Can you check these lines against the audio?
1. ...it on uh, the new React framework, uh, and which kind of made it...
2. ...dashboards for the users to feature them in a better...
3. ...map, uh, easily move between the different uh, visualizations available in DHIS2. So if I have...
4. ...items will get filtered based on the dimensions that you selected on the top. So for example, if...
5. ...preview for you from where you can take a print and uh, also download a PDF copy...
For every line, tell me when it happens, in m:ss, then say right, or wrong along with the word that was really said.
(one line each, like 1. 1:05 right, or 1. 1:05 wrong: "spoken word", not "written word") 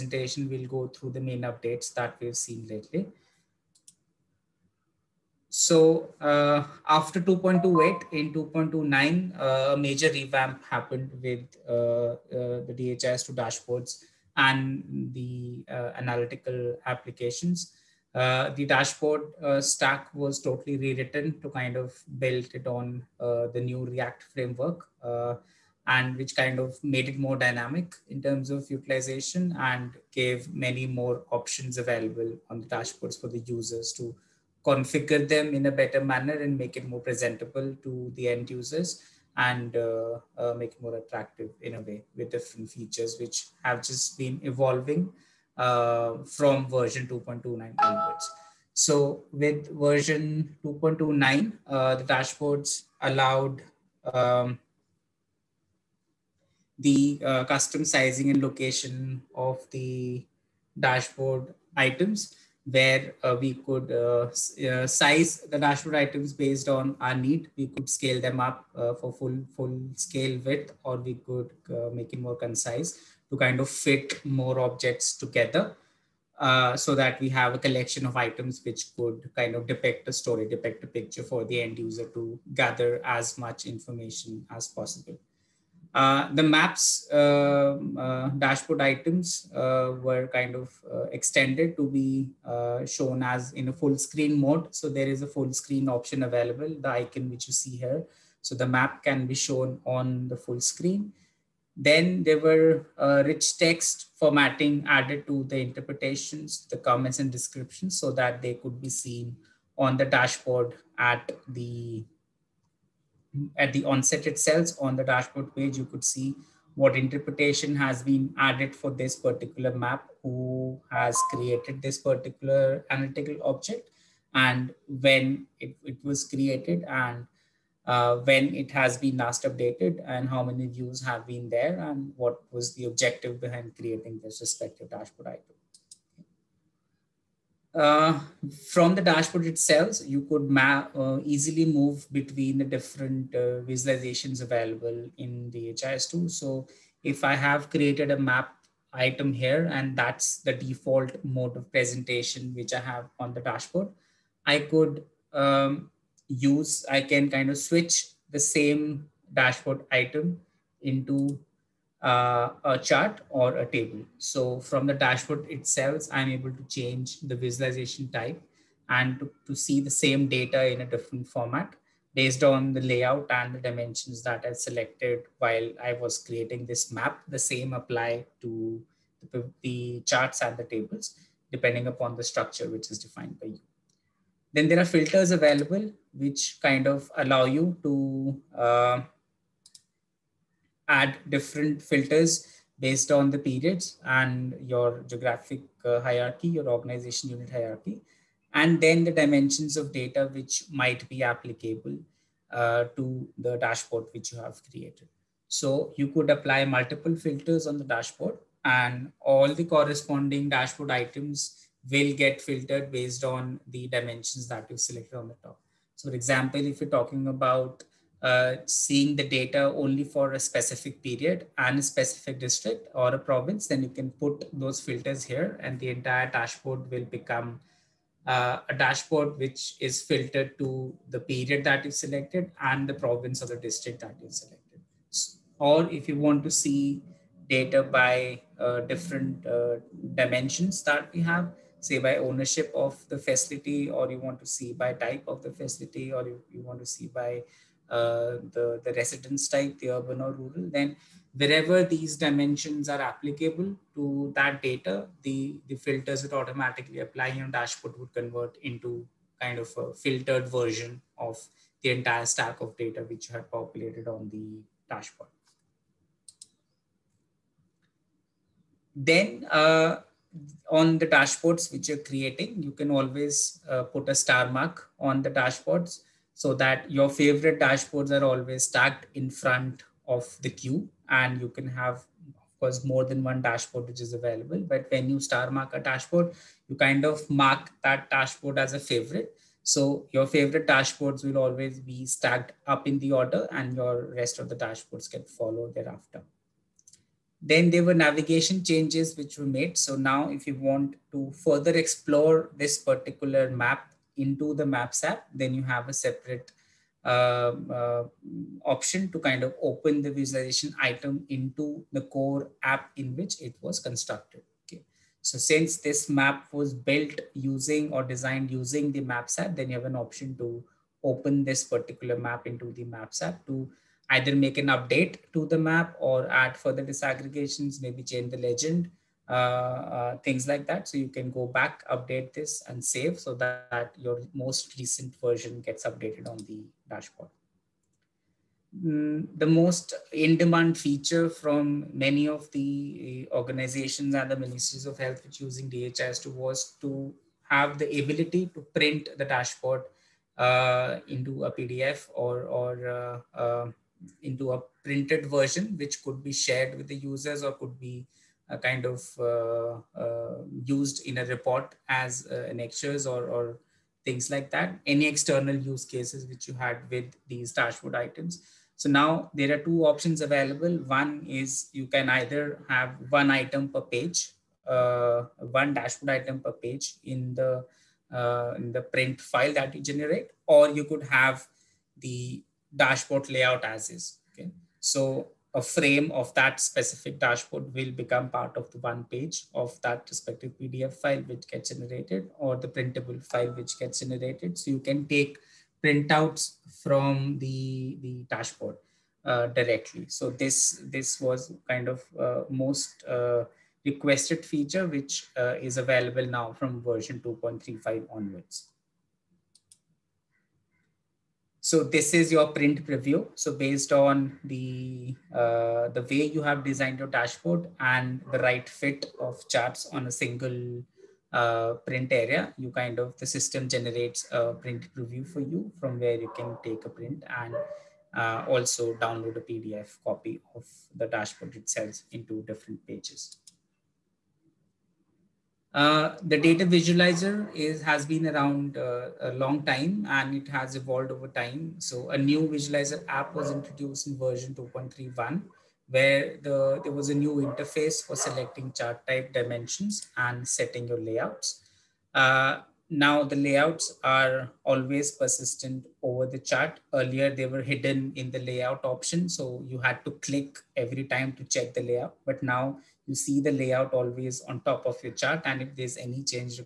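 1. 0:22 right
2. 0:32 wrong: "configure", not "feature"
3. 2:20 right
4. 3:30 right
5. 7:04 right.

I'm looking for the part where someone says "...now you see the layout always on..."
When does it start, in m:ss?
7:42.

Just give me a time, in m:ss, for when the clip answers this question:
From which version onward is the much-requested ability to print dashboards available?
6:46.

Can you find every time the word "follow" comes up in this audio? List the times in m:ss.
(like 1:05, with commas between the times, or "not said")
4:55.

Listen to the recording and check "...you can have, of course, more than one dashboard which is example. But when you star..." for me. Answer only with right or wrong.
wrong.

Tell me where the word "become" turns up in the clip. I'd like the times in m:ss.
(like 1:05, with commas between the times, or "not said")
3:47, 6:27.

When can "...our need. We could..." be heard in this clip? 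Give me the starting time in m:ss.
1:07.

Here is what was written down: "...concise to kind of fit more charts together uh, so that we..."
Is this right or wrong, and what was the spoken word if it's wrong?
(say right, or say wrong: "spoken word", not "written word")
wrong: "objects", not "charts".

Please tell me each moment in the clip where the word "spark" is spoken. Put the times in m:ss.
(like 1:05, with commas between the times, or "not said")
not said.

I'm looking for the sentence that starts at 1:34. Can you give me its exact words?
So there is a full screen option available, the icon which you see here.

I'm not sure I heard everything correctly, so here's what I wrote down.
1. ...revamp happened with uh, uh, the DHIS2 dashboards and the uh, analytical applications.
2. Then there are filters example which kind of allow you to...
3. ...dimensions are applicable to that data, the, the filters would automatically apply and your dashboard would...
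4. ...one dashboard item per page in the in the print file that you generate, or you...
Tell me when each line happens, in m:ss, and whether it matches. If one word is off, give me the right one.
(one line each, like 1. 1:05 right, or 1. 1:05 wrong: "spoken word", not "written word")
1. 0:10 right
2. 3:04 wrong: "available", not "example"
3. 4:12 right
4. 6:15 right.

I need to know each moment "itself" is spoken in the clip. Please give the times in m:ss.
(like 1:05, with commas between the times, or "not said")
1:54, 2:19, 2:45, 7:11.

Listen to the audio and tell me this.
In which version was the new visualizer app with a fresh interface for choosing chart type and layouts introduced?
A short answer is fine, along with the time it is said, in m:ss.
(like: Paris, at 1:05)
2.31, at 7:24.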